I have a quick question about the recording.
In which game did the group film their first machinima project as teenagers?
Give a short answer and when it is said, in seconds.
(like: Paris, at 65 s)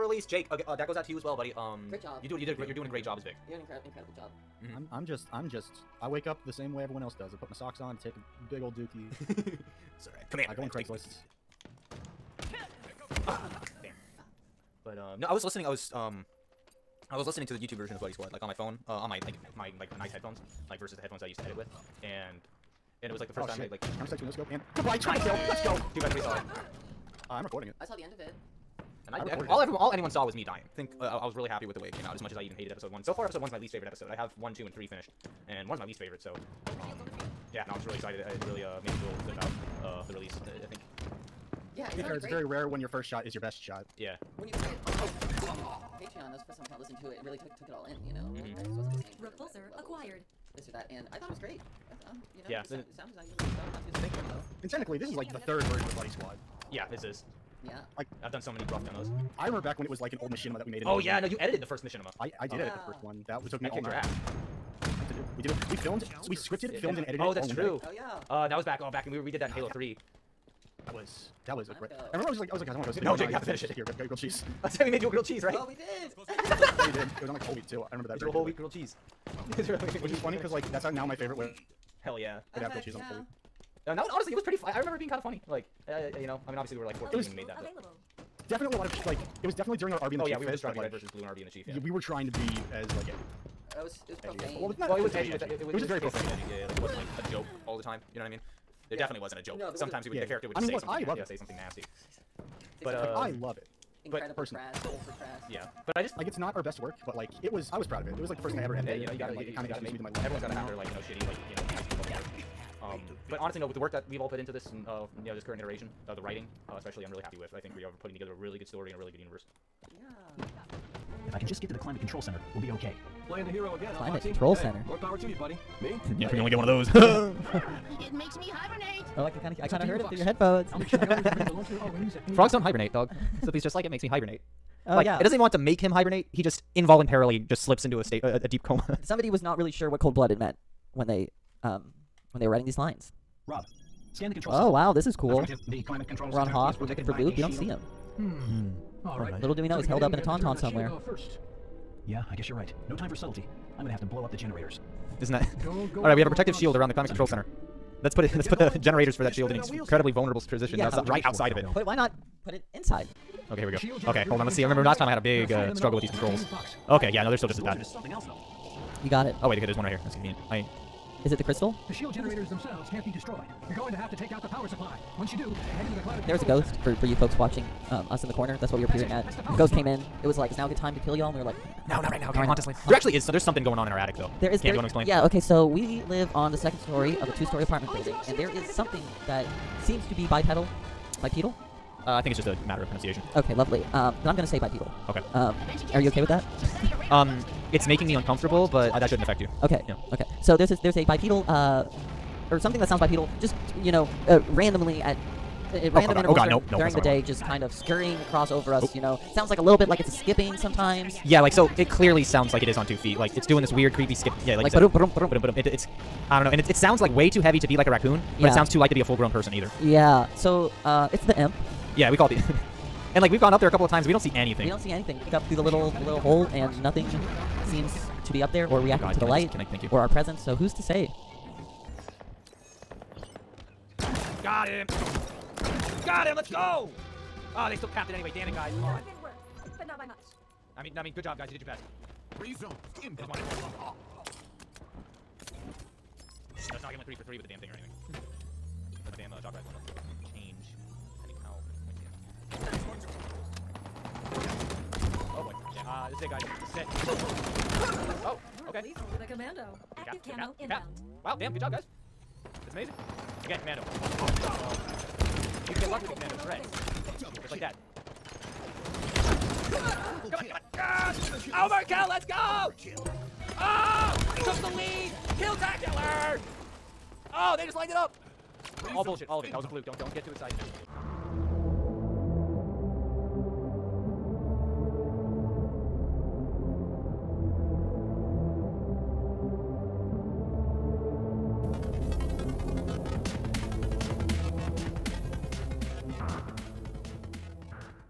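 Halo 3, at 69 s.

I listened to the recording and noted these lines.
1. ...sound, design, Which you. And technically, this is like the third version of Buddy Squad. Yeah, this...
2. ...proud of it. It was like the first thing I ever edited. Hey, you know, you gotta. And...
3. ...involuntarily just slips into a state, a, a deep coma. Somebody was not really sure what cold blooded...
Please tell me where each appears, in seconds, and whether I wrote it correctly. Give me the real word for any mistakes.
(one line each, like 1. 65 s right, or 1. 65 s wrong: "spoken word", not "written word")
1. 52 s wrong: "Thank", not "Which"
2. 107 s right
3. 136 s right.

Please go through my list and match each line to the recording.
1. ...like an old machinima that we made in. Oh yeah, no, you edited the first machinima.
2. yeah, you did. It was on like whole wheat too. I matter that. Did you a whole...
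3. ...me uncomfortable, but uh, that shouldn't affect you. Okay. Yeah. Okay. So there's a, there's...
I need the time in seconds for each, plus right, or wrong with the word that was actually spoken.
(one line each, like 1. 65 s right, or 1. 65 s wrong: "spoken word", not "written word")
1. 60 s right
2. 76 s wrong: "remember", not "matter"
3. 198 s right.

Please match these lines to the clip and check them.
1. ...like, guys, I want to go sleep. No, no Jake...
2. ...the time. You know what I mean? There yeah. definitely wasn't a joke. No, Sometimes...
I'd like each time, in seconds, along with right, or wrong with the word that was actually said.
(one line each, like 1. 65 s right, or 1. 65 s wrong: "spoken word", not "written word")
1. 72 s right
2. 97 s right.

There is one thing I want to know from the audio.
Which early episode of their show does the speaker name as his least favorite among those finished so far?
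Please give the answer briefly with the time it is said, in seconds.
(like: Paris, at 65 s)
Episode 1, at 33 s.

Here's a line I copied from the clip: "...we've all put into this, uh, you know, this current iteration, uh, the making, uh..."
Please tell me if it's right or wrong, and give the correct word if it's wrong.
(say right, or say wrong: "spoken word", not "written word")
wrong: "writing", not "making".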